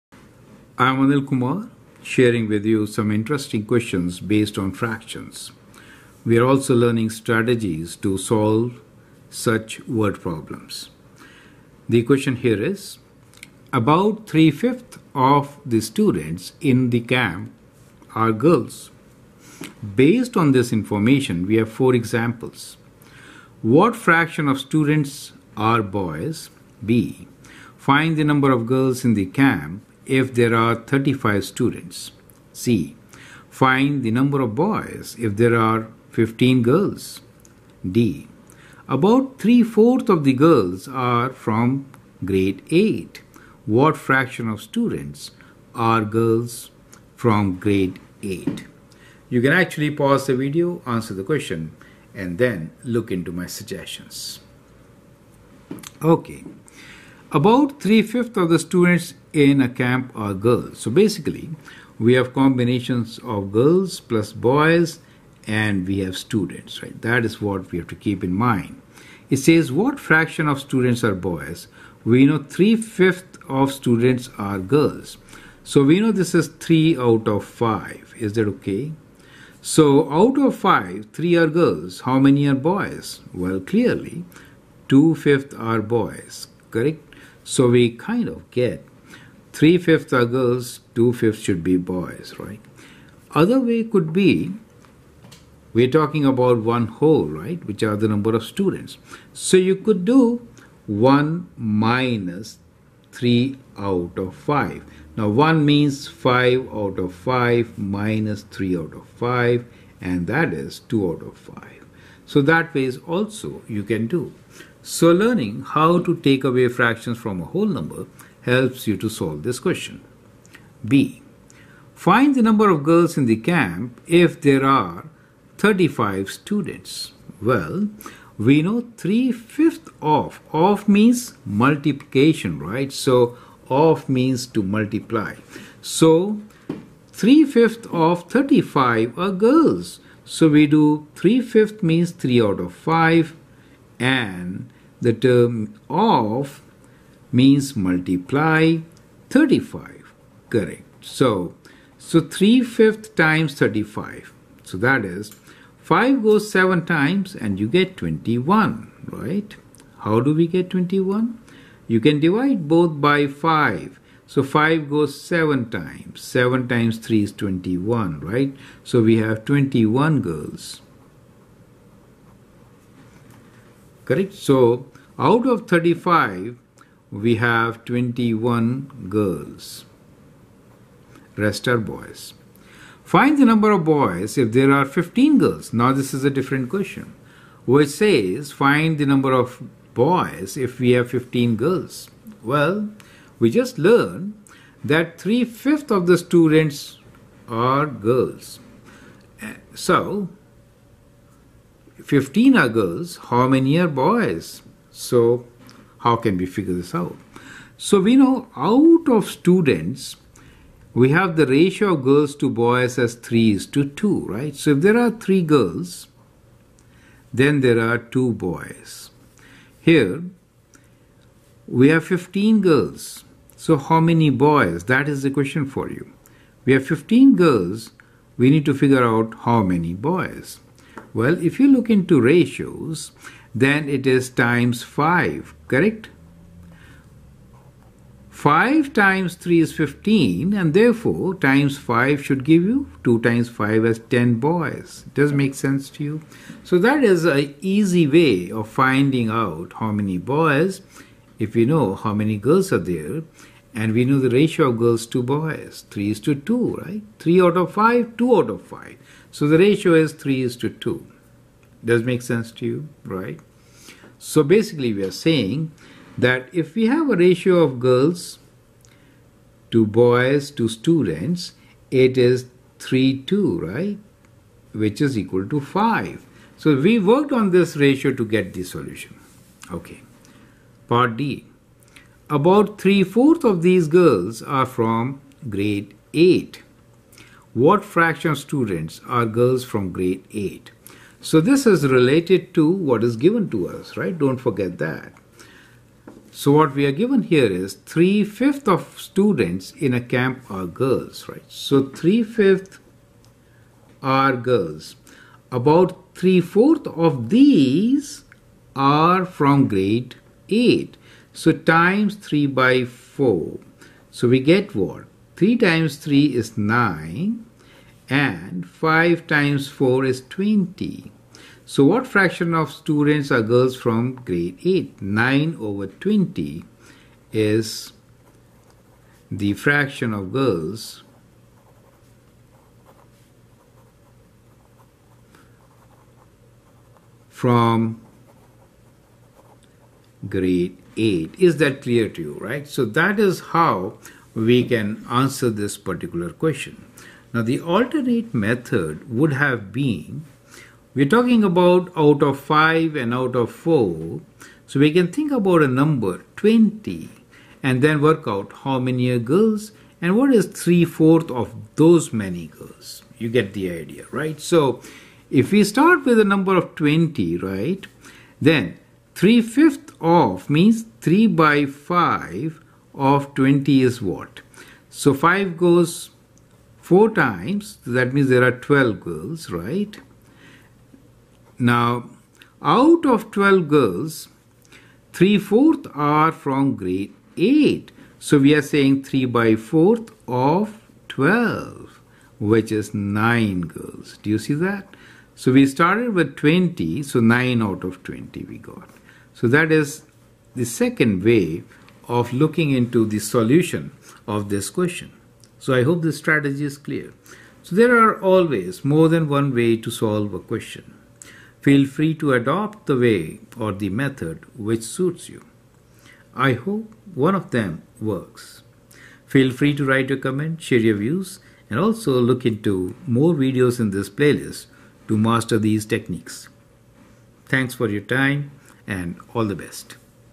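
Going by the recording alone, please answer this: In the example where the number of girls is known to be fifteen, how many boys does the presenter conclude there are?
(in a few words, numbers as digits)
10.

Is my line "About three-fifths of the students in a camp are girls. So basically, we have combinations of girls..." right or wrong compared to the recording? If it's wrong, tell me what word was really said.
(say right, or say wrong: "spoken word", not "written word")
right.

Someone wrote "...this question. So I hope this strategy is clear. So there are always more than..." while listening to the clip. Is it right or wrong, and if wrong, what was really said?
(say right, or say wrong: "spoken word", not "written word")
right.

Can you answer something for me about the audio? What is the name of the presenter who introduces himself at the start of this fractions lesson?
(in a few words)
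Anil Kumar.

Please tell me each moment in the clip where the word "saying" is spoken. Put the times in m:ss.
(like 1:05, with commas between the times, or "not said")
4:25, 6:28.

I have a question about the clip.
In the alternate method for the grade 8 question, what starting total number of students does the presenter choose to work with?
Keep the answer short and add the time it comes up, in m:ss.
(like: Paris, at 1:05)
20, at 6:06.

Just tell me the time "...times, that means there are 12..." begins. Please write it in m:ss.
6:17.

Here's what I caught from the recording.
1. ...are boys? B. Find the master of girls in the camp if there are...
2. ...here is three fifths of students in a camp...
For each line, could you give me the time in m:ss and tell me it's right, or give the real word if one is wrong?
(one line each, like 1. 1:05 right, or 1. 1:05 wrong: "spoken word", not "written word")
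1. 0:25 wrong: "number", not "master"
2. 4:57 right.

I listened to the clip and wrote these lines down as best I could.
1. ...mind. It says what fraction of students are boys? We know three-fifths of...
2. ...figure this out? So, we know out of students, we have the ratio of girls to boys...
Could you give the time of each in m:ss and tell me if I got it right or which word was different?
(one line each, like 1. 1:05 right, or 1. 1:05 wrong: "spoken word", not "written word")
1. 1:08 right
2. 3:26 right.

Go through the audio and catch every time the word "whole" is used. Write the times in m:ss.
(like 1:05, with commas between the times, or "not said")
1:36, 1:57.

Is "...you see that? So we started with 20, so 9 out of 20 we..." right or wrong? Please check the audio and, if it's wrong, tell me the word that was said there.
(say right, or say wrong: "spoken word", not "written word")
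right.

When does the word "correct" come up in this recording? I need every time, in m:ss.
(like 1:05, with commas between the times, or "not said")
1:26, 2:30, 2:54, 3:55.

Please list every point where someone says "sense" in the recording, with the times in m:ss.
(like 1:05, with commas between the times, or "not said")
4:05, 4:22.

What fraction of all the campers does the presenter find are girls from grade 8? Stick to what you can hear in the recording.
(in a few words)
9/20.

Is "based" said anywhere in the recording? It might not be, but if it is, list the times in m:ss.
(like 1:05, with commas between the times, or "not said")
0:04, 0:19.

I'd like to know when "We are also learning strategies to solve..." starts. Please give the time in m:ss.
0:06.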